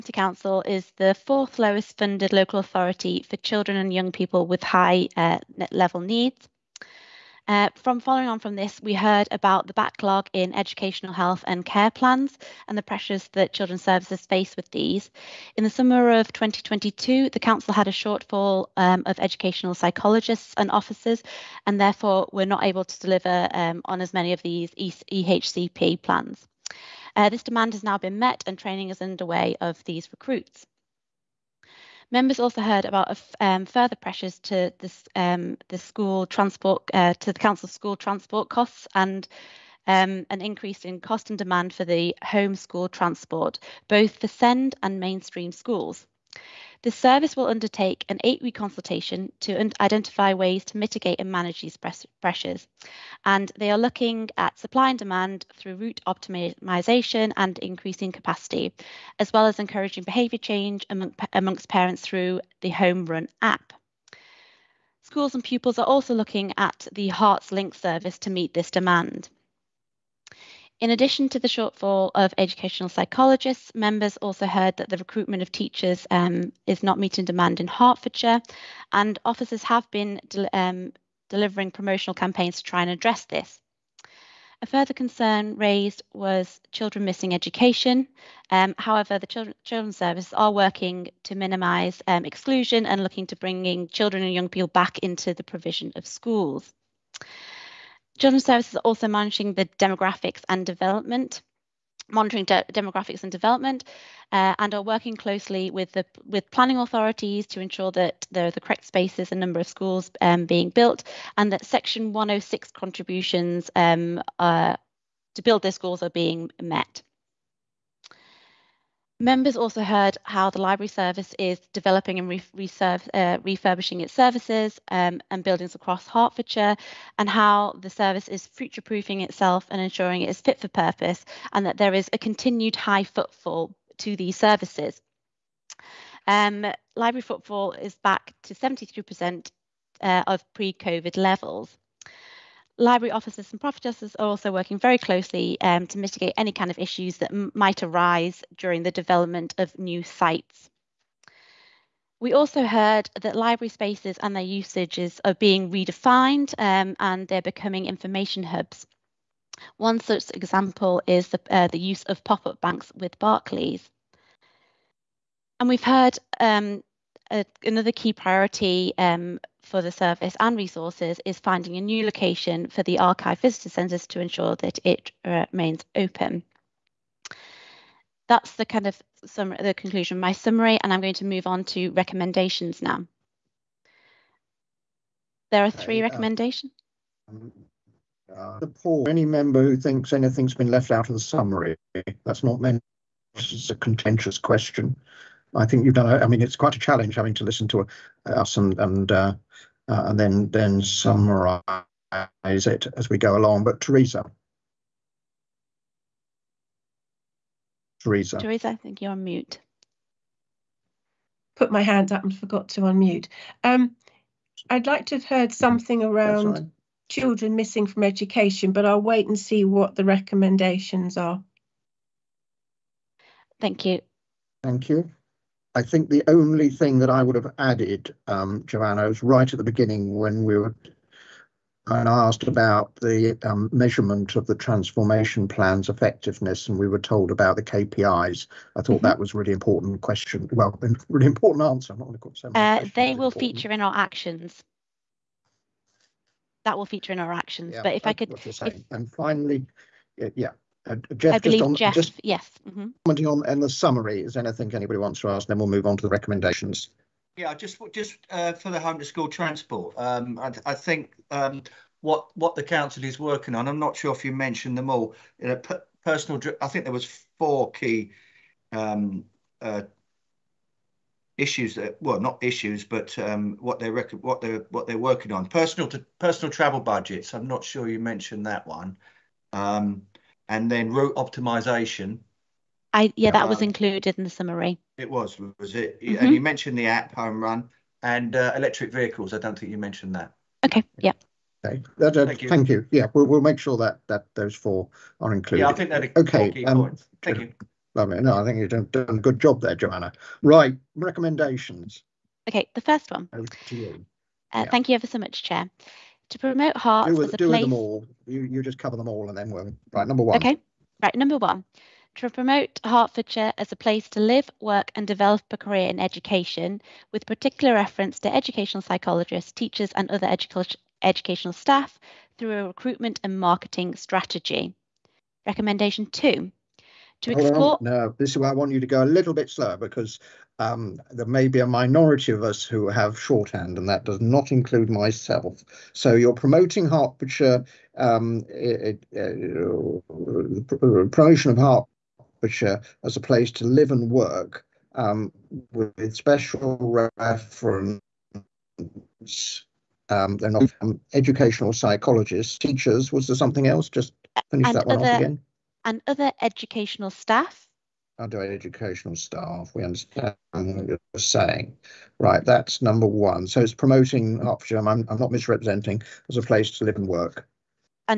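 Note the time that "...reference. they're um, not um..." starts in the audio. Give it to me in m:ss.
5:47.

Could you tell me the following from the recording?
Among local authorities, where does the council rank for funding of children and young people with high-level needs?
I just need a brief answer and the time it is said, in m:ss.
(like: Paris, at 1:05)
fourth lowest, at 0:01.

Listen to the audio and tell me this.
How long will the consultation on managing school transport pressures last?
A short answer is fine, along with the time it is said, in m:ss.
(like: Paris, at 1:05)
8 weeks, at 0:48.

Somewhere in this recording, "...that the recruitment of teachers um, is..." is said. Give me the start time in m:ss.
1:14.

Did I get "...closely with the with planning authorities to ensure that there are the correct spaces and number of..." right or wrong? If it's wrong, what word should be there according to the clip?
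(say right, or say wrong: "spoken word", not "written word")
right.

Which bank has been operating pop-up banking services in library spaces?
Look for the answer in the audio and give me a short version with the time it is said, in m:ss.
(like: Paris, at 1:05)
Barclays, at 2:43.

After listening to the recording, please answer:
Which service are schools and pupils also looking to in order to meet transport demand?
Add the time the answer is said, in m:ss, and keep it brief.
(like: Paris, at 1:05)
HertsLynx, at 1:07.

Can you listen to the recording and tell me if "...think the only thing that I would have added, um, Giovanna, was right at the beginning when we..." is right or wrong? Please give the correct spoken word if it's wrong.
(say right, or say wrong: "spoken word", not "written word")
right.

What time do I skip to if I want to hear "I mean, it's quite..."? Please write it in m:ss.
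3:16.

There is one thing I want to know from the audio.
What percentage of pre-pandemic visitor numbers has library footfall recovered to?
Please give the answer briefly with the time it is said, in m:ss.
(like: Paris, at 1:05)
73%, at 2:18.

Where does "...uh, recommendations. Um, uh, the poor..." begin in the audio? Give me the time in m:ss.
3:06.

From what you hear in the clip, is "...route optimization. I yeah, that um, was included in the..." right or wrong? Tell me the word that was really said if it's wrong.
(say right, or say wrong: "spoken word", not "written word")
right.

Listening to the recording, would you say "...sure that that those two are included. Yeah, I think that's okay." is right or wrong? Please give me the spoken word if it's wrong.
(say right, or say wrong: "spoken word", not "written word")
wrong: "four", not "two".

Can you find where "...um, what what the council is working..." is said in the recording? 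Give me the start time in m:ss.
4:21.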